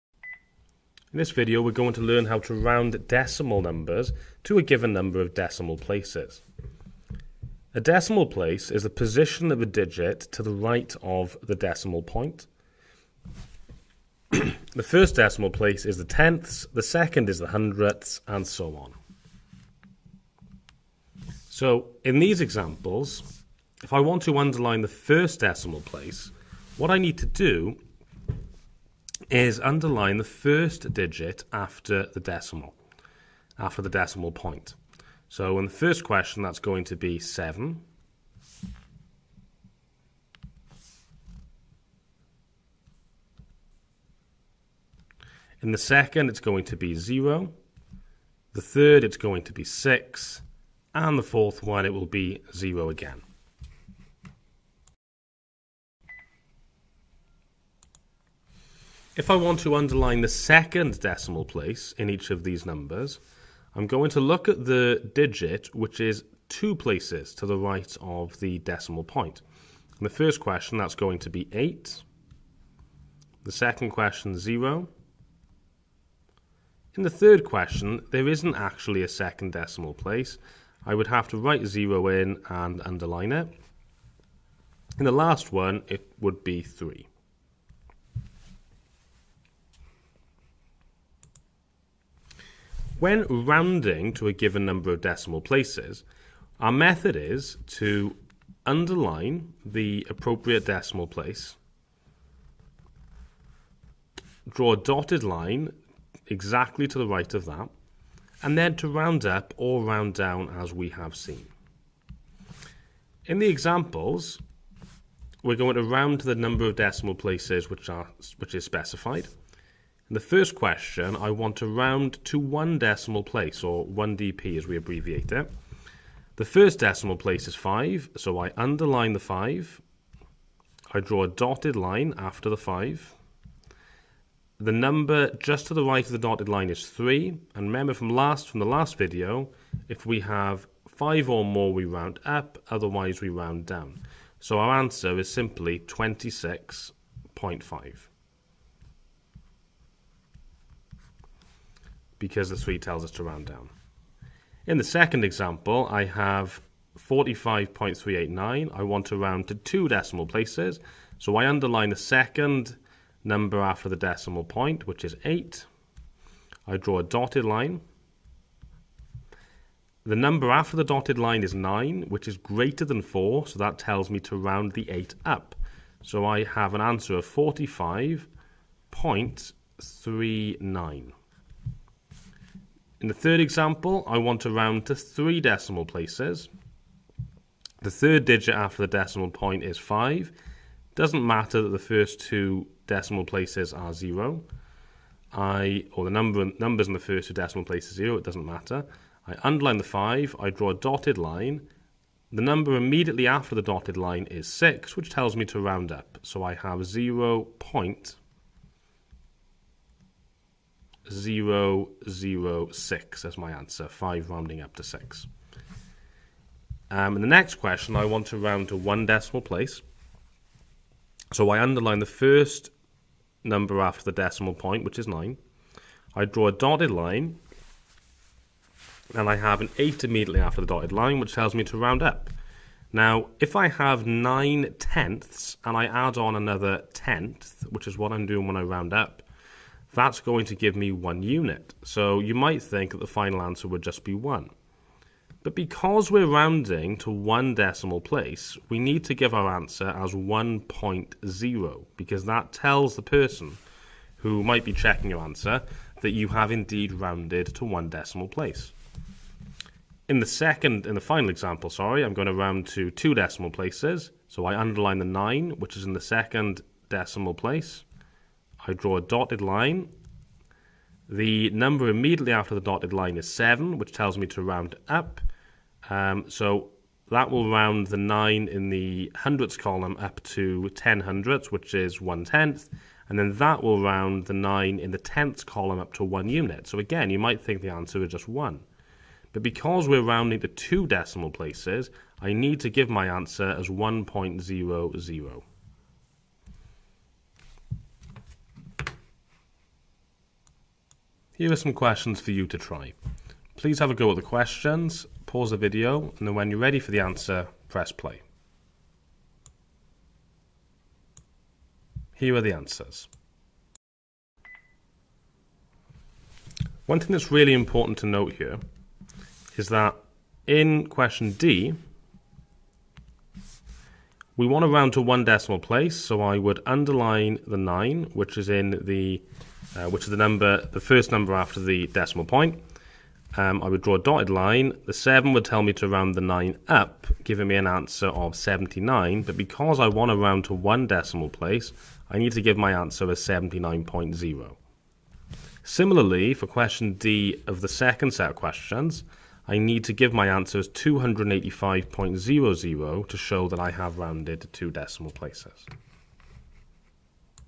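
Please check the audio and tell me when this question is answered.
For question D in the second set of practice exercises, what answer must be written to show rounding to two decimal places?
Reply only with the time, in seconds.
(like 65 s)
350 s.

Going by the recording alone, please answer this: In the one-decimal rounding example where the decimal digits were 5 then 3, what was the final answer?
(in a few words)
26.5.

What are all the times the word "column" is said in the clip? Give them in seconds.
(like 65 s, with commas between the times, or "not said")
279 s, 285 s.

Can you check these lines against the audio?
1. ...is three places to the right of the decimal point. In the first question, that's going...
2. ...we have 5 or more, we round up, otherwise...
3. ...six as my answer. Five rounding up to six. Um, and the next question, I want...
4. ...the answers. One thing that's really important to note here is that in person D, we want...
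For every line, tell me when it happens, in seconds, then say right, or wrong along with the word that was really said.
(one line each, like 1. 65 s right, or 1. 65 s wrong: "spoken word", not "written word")
1. 65 s wrong: "two", not "three"
2. 140 s right
3. 212 s right
4. 312 s wrong: "question", not "person".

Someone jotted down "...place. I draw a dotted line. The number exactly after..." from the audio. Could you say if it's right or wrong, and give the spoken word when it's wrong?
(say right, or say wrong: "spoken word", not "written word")
wrong: "immediately", not "exactly".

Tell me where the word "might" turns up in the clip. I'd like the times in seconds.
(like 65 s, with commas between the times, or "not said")
242 s, 254 s, 287 s.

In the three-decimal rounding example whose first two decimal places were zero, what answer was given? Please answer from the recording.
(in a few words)
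0.006.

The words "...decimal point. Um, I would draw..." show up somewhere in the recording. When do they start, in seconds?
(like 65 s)
331 s.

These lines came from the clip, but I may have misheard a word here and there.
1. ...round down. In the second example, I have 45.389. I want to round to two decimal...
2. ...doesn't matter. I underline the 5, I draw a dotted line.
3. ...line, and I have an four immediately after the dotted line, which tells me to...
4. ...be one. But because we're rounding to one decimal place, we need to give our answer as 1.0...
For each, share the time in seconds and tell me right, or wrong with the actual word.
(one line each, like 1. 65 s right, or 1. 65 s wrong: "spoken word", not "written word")
1. 153 s right
2. 198 s right
3. 226 s wrong: "eight", not "four"
4. 244 s right.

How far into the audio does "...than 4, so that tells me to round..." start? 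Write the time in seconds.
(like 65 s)
172 s.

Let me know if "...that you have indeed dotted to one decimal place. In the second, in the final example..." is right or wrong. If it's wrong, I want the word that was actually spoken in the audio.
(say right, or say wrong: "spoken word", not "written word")
wrong: "rounded", not "dotted".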